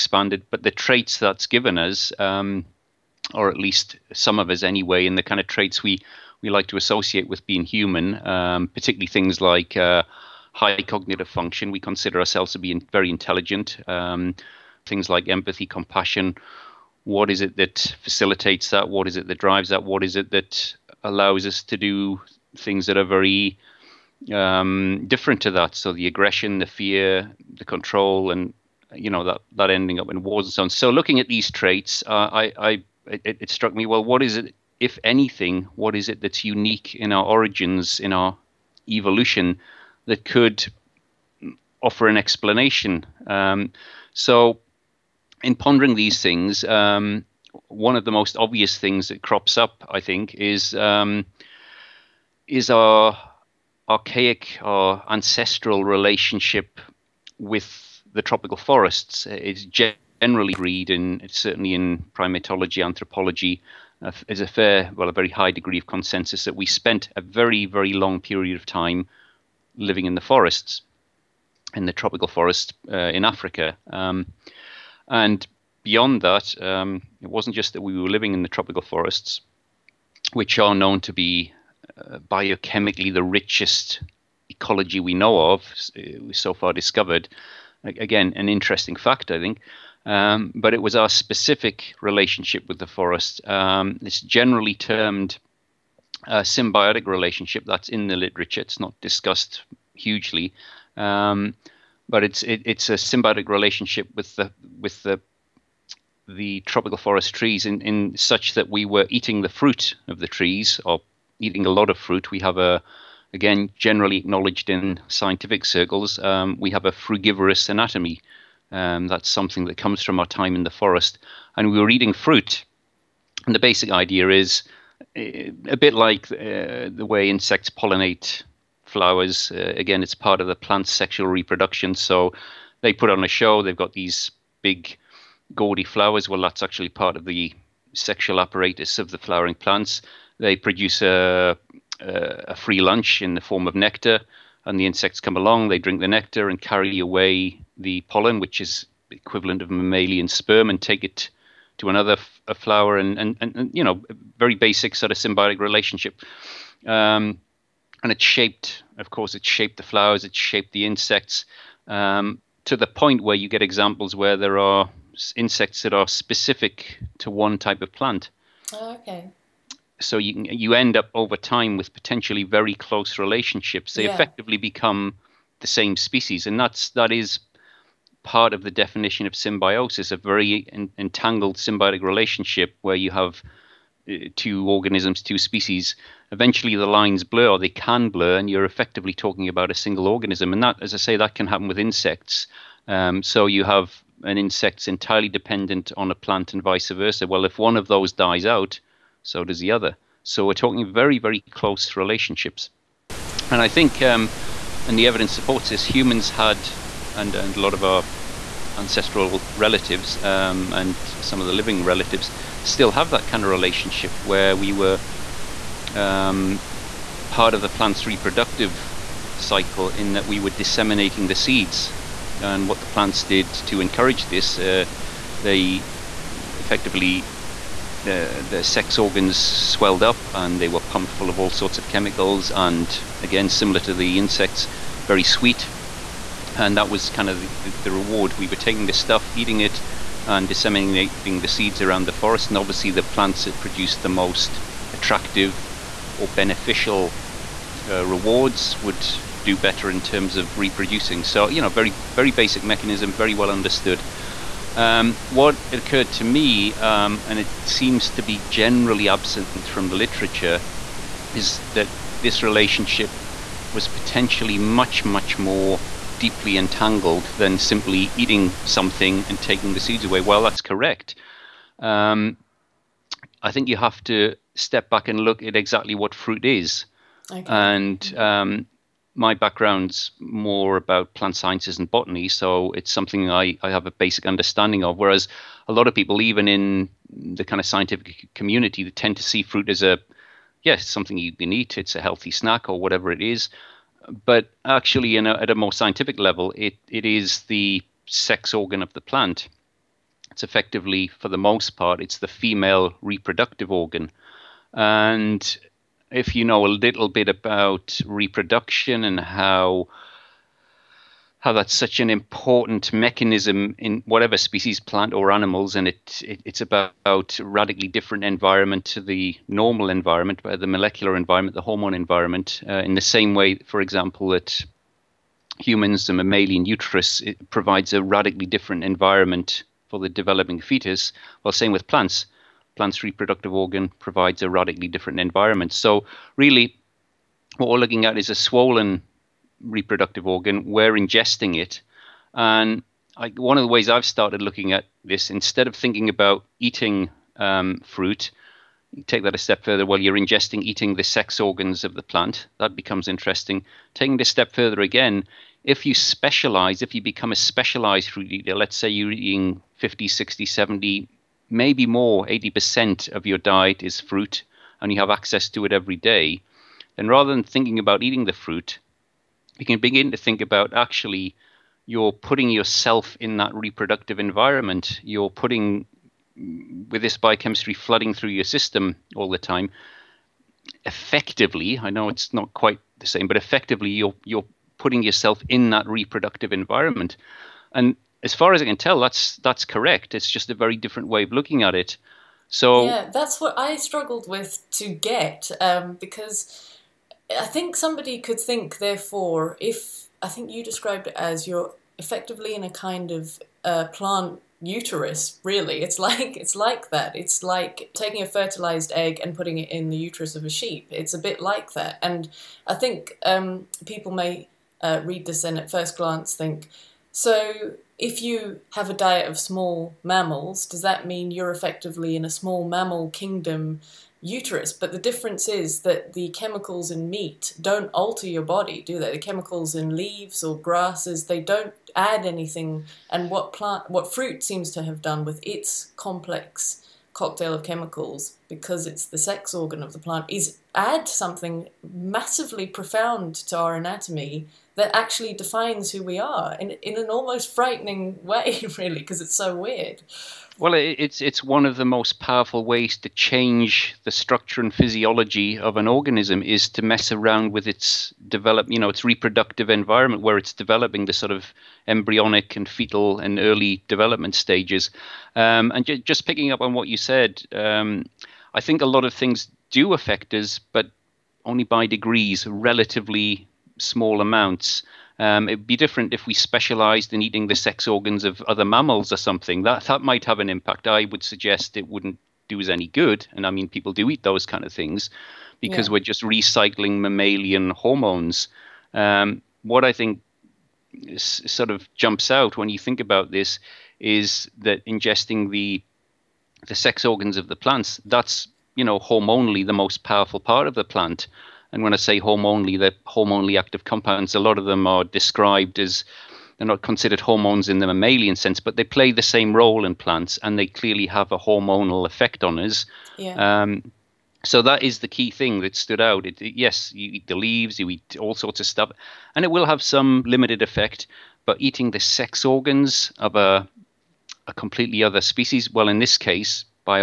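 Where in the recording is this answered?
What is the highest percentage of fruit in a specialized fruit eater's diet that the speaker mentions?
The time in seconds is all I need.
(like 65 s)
362 s.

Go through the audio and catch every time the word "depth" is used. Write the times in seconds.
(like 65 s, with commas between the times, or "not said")
not said.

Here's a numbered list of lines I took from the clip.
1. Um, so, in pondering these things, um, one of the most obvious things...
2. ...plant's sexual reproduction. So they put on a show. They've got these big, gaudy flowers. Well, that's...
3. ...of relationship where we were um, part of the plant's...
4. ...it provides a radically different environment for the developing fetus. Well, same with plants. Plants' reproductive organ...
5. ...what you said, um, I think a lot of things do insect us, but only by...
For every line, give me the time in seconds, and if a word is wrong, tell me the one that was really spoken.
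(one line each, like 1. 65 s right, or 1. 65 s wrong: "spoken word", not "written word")
1. 43 s right
2. 130 s right
3. 213 s right
4. 327 s right
5. 466 s wrong: "affect", not "insect".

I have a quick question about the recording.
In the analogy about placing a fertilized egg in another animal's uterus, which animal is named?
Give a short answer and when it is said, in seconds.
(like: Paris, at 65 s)
sheep, at 410 s.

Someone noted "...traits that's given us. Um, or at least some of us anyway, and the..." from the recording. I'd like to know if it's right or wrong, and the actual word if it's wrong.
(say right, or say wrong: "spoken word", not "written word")
right.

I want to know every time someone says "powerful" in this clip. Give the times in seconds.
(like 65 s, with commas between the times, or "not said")
452 s, 500 s.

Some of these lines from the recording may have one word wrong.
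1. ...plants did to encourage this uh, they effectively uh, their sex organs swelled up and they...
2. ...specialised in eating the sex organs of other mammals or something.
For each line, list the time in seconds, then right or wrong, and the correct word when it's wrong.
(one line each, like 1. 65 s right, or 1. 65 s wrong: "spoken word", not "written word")
1. 222 s right
2. 476 s right.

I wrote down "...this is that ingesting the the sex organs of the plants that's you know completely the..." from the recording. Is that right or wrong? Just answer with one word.
wrong.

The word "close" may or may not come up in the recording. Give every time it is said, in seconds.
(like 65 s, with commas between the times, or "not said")
172 s, 201 s.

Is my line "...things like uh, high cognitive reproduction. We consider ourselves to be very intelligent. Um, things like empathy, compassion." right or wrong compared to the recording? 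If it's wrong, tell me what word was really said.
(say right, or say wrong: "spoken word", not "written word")
wrong: "function", not "reproduction".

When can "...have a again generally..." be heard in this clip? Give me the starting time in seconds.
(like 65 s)
112 s.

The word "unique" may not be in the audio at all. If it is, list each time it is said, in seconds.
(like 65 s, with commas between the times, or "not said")
36 s.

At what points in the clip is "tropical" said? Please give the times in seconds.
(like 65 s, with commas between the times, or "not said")
58 s, 71 s, 78 s, 106 s.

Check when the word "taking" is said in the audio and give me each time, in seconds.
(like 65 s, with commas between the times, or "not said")
238 s, 269 s, 353 s, 407 s.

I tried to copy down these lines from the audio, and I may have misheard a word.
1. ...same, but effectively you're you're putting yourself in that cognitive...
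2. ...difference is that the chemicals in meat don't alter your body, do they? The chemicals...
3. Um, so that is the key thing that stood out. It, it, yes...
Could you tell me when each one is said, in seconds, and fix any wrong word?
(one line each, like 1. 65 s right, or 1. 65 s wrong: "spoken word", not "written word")
1. 383 s wrong: "reproductive", not "cognitive"
2. 424 s right
3. 513 s right.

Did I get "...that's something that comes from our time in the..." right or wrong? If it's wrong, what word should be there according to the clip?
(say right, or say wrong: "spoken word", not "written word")
right.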